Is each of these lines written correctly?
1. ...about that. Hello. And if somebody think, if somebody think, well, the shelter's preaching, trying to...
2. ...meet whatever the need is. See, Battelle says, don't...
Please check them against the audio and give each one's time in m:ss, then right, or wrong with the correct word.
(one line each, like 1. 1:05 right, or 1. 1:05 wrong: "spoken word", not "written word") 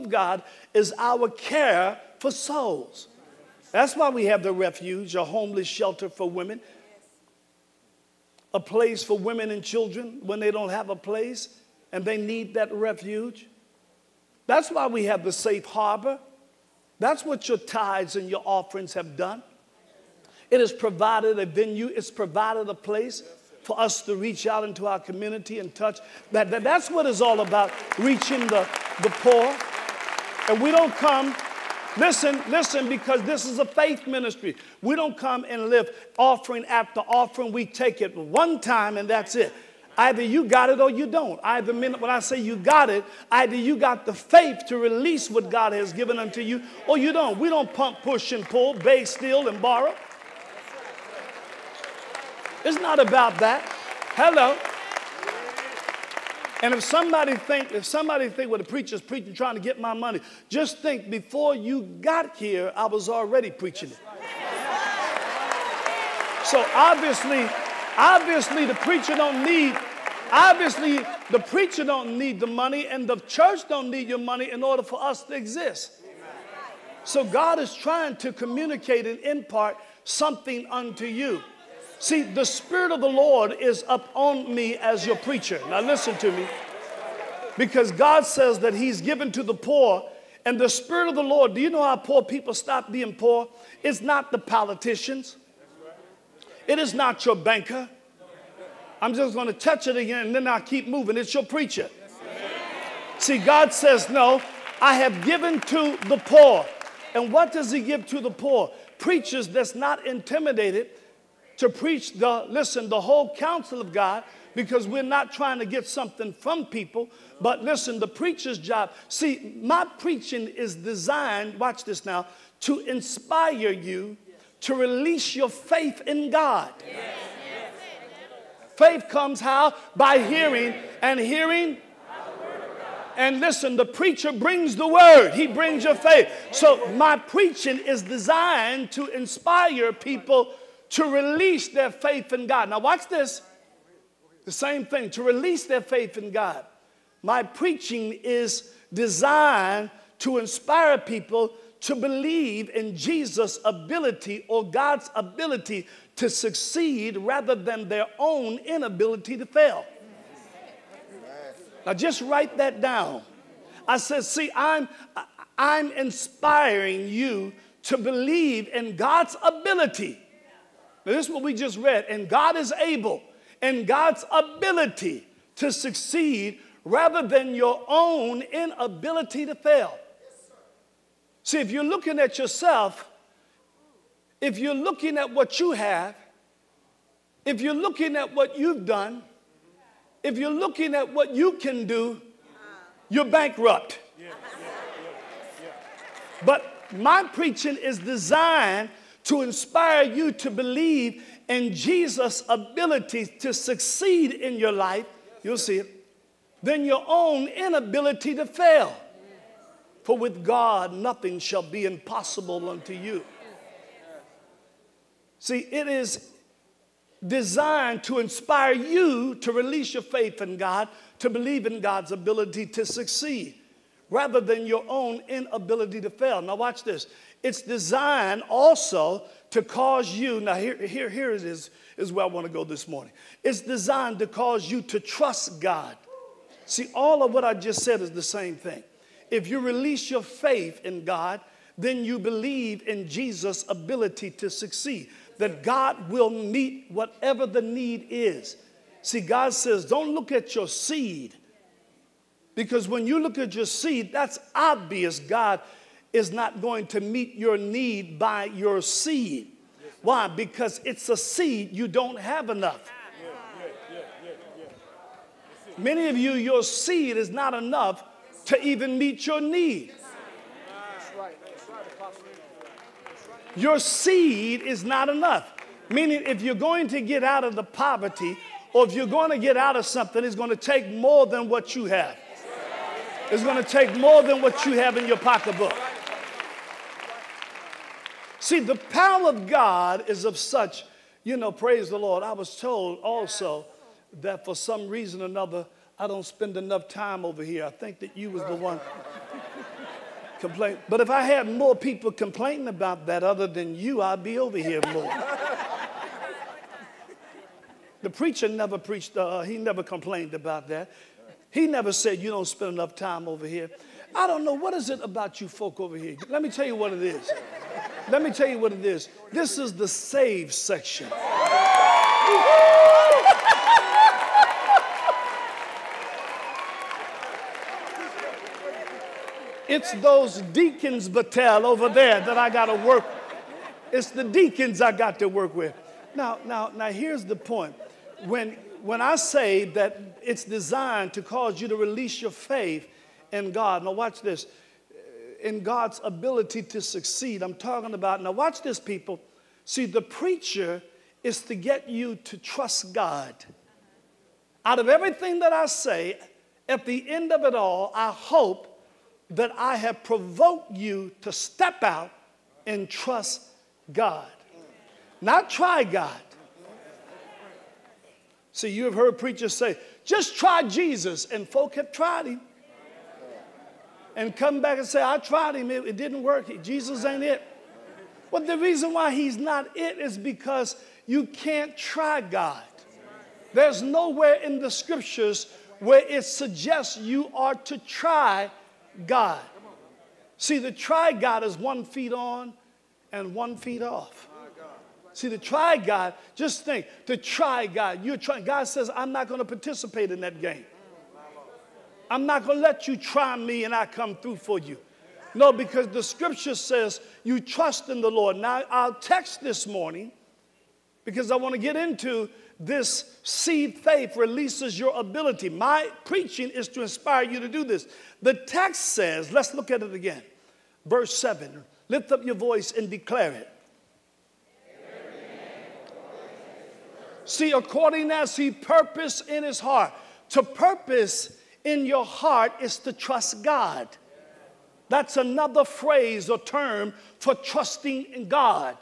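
1. 0:52 wrong: "preacher", not "shelter"
2. 4:06 wrong: "God", not "Battelle".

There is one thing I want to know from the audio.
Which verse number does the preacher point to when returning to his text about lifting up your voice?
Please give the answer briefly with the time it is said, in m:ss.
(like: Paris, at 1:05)
7, at 7:00.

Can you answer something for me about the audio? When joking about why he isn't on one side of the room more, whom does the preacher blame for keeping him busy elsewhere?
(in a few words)
the deacons.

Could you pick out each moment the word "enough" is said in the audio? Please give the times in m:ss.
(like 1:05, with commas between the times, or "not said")
4:22, 4:27, 4:35, 4:56, 5:12.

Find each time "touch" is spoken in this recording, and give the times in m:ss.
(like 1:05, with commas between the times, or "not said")
0:25, 1:39.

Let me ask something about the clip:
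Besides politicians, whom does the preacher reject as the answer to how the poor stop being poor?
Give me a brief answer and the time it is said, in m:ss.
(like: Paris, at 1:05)
your banker, at 1:37.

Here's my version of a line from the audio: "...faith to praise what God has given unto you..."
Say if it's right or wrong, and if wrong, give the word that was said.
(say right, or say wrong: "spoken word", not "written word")
wrong: "release", not "praise".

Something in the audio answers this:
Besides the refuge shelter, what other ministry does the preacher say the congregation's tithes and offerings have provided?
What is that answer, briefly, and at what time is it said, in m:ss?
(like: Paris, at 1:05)
the safe harbor, at 0:15.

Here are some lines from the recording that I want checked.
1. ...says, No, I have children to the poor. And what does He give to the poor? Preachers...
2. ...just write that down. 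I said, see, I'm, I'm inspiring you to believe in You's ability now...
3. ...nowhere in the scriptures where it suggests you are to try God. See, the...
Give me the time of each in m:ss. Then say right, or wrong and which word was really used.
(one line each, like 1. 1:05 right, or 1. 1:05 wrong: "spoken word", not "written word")
1. 1:43 wrong: "given", not "children"
2. 2:41 wrong: "God", not "You"
3. 6:23 right.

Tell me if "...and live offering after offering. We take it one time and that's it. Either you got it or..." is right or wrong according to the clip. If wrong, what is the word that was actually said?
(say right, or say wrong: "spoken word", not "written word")
right.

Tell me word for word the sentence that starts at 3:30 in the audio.
For with God, nothing shall be impossible unto you.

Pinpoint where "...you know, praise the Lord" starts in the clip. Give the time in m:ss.
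4:51.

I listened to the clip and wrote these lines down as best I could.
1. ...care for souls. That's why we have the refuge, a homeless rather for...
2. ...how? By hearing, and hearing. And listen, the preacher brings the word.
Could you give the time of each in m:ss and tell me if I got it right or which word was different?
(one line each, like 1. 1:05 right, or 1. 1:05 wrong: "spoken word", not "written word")
1. 0:01 wrong: "shelter", not "rather"
2. 2:09 right.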